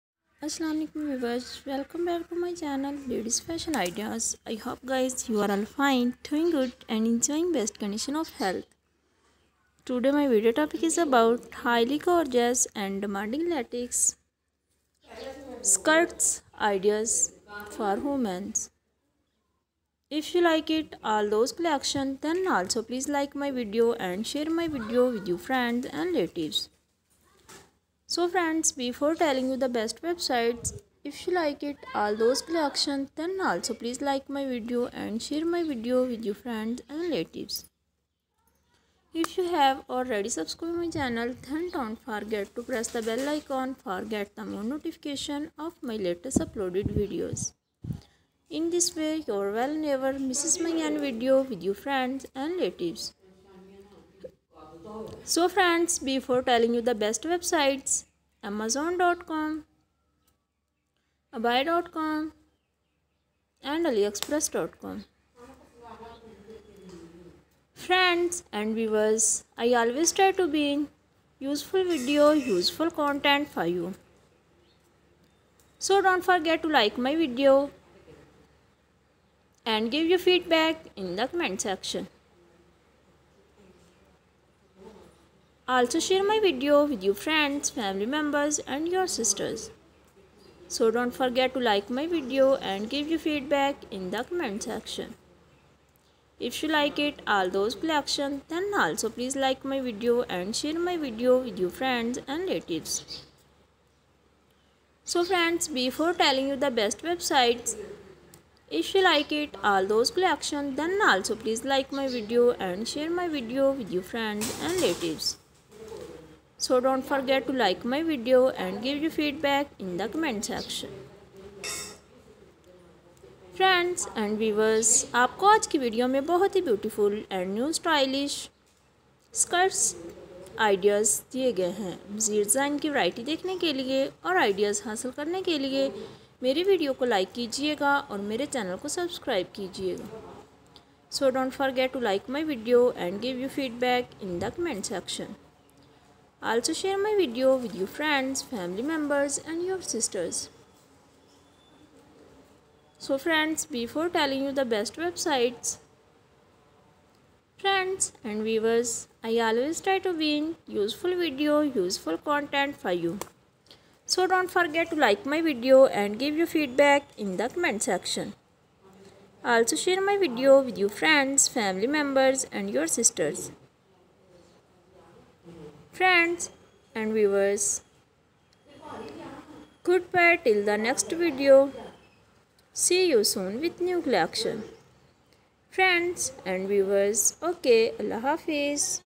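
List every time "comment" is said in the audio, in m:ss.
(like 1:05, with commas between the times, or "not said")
1:21, 1:34, 2:00, 2:47.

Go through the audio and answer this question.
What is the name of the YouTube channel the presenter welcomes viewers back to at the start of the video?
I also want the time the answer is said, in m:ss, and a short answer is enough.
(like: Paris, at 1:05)
Ladies Fashion Ideas, at 0:03.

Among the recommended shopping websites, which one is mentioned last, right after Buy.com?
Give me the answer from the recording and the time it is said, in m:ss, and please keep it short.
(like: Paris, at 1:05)
AliExpress.com, at 1:03.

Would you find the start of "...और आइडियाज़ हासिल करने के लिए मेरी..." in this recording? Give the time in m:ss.
2:14.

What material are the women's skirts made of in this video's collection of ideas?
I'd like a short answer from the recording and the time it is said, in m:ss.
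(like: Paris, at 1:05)
Latex, at 0:13.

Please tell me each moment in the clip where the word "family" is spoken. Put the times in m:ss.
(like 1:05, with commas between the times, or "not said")
1:27, 2:28, 2:51.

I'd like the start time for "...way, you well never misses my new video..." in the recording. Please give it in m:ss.
0:48.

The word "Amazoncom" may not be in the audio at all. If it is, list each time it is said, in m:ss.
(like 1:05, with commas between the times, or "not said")
0:58.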